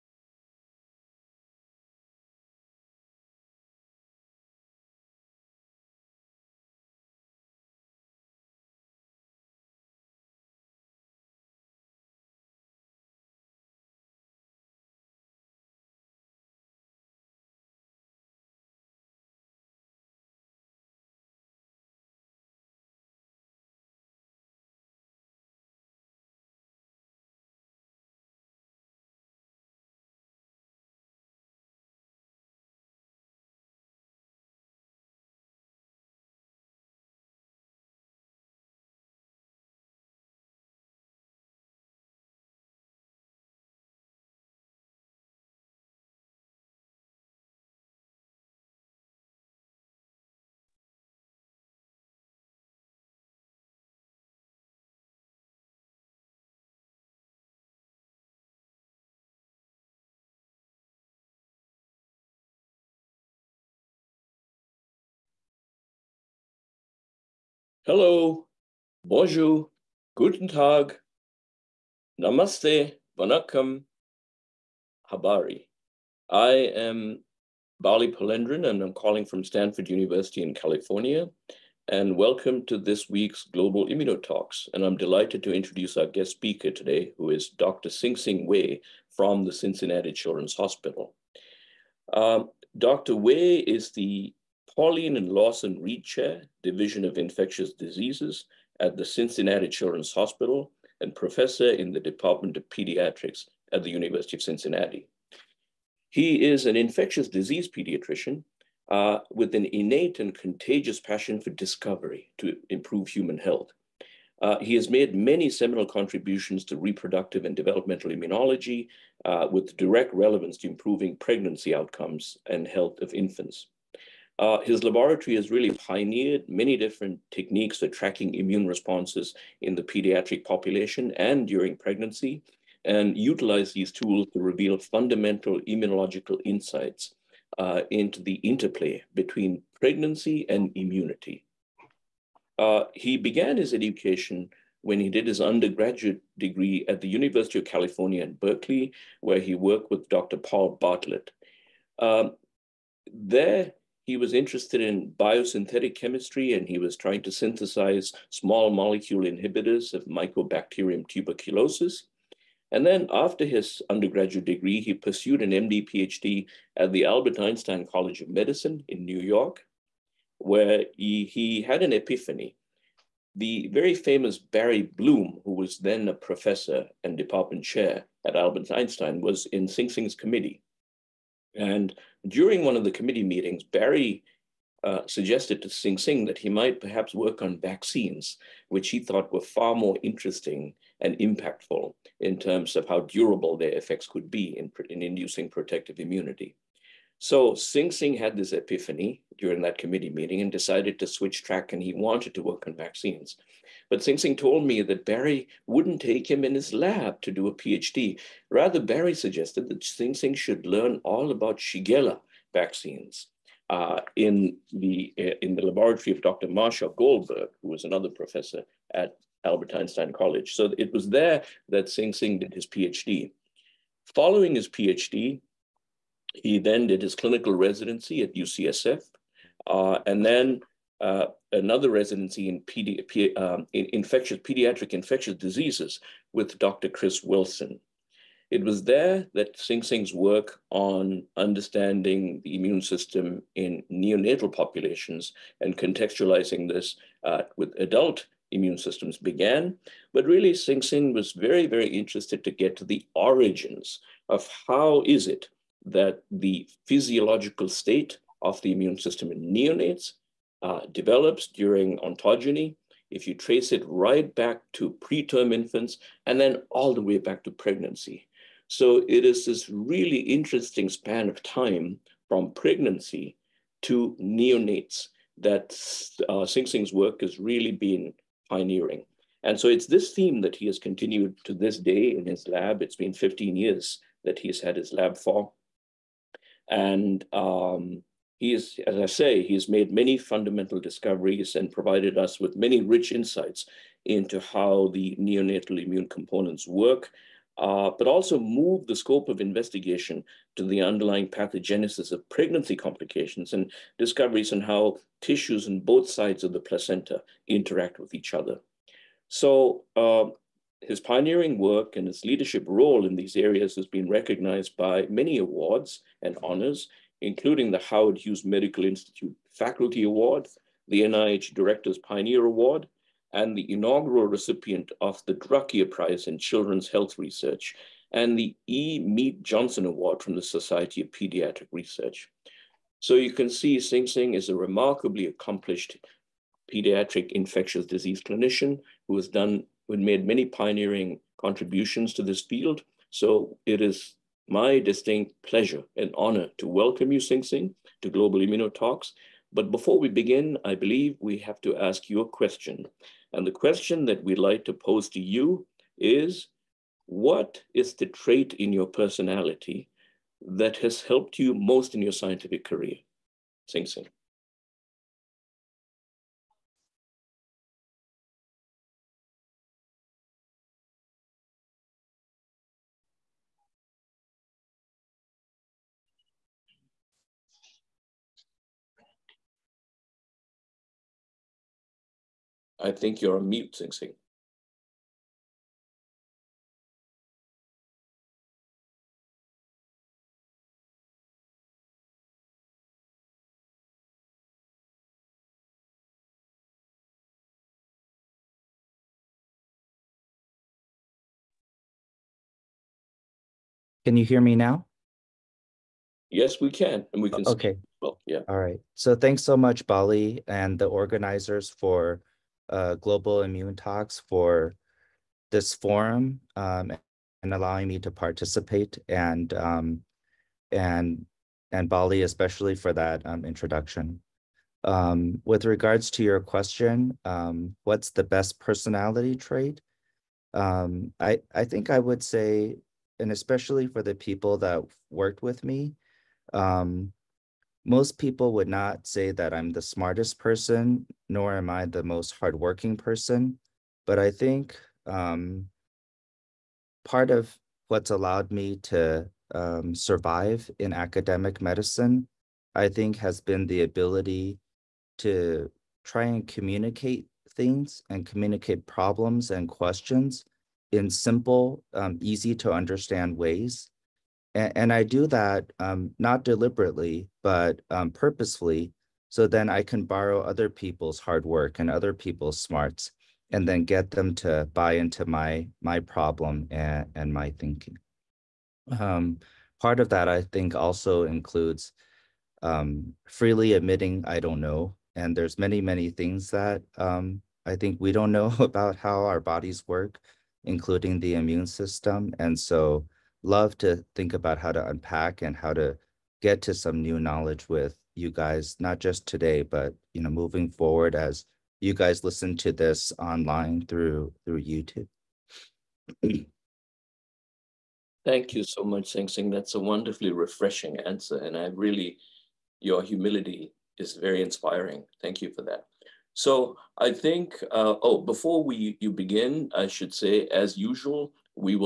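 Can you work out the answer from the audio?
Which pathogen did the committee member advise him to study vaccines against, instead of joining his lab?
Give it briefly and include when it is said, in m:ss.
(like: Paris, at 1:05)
Shigella, at 3:31.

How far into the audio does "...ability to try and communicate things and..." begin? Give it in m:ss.
7:33.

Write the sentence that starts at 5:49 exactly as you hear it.
But before we begin, I believe we have to ask you a question.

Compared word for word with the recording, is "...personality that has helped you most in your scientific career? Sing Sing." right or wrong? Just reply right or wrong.
right.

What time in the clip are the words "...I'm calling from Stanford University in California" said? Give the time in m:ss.
1:18.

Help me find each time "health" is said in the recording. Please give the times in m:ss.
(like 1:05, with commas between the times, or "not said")
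1:53, 2:02, 5:26.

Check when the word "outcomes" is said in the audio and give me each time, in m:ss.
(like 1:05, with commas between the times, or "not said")
2:01.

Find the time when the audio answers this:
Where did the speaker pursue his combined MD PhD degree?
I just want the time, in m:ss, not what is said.
2:47.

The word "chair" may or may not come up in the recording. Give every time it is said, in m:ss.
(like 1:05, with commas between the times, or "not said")
1:36, 2:57.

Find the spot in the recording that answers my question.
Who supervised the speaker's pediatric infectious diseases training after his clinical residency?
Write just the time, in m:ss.
3:56.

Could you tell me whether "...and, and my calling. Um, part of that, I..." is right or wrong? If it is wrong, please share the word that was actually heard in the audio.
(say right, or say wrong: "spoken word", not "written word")
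wrong: "thinking", not "calling".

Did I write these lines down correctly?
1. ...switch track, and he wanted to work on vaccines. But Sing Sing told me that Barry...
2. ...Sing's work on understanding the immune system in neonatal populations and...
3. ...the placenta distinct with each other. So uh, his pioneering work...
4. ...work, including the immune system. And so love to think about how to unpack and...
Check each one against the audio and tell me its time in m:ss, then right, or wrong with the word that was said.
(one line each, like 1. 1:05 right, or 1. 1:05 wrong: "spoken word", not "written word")
1. 3:21 right
2. 3:59 right
3. 5:06 wrong: "interact", not "distinct"
4. 8:09 right.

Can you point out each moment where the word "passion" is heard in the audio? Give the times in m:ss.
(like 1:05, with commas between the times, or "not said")
1:50.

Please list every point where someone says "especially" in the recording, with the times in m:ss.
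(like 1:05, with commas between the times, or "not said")
7:02, 7:13.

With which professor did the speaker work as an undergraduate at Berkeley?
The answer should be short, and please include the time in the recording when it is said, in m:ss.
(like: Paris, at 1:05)
Paul Bartlett, at 2:30.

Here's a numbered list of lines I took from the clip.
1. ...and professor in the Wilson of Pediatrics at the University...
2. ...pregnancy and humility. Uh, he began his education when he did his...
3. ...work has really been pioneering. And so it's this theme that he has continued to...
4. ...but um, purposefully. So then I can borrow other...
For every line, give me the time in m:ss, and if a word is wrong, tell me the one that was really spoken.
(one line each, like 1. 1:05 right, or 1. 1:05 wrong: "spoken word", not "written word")
1. 1:41 wrong: "Department", not "Wilson"
2. 2:19 wrong: "immunity", not "humility"
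3. 4:36 right
4. 7:47 right.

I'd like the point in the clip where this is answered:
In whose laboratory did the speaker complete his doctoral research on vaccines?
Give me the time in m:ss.
3:36.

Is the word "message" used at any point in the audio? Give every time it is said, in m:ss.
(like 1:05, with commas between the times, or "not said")
not said.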